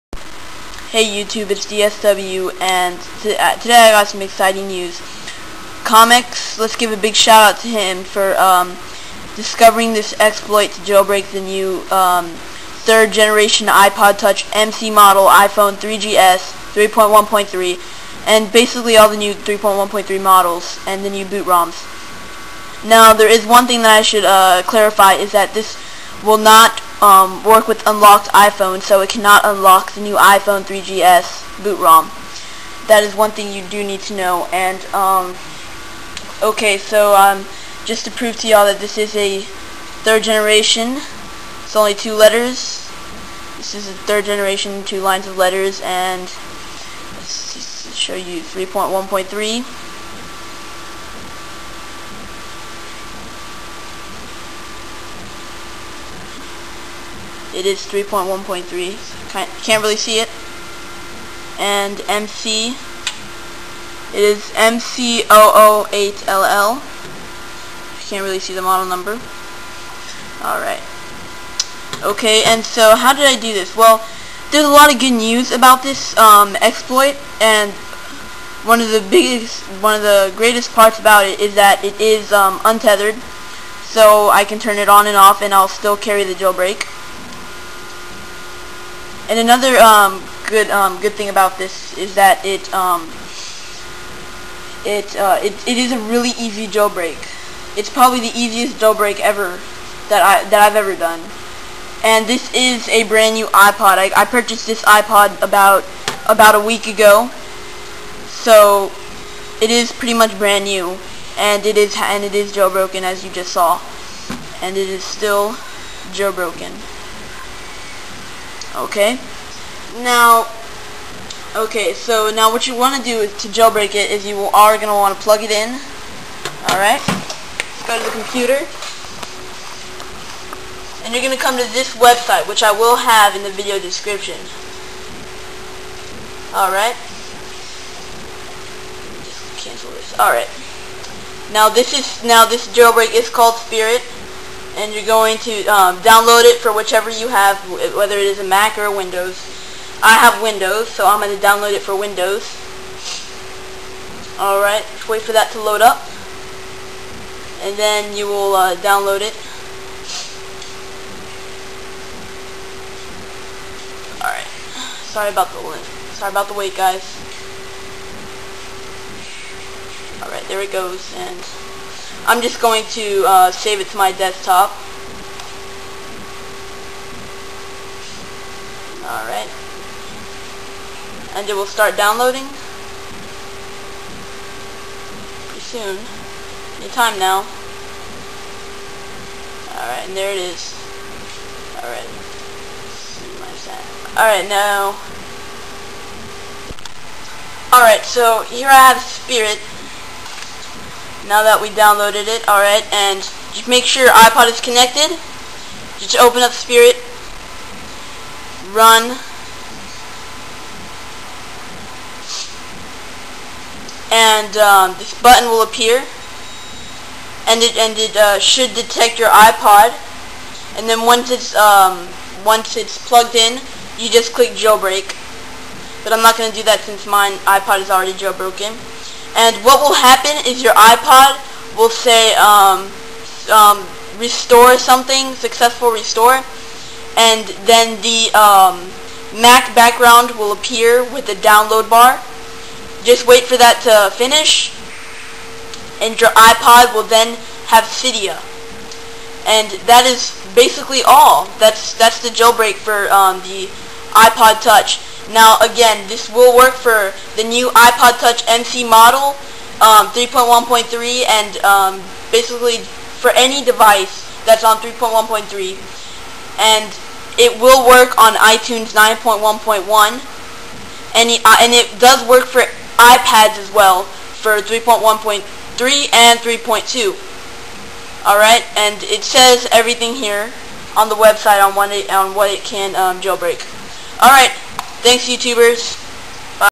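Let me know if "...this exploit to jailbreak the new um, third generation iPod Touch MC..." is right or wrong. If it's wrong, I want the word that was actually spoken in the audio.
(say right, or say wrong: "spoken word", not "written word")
right.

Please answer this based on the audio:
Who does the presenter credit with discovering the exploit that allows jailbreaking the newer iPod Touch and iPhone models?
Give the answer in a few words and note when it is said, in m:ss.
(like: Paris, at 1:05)
Comex, at 0:05.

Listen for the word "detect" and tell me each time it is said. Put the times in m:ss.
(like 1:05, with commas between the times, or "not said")
3:38.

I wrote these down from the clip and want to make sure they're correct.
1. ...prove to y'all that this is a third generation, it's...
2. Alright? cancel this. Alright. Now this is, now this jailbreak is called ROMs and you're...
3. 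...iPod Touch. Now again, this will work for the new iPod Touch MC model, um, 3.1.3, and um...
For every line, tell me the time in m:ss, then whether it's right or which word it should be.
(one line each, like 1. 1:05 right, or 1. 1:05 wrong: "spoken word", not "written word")
1. 0:38 right
2. 2:16 wrong: "Spirit", not "ROMs"
3. 4:14 right.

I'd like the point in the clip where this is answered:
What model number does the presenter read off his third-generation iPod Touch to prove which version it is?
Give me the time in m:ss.
1:04.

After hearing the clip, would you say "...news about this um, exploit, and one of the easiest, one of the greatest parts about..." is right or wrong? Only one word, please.
wrong.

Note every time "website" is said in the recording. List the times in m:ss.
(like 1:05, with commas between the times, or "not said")
2:11, 4:41.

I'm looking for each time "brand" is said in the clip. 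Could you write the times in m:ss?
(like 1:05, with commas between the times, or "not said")
1:43, 1:50.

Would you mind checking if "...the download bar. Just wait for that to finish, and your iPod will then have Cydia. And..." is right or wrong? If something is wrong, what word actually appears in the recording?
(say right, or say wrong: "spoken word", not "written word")
right.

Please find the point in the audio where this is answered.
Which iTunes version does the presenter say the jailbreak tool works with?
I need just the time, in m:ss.
4:28.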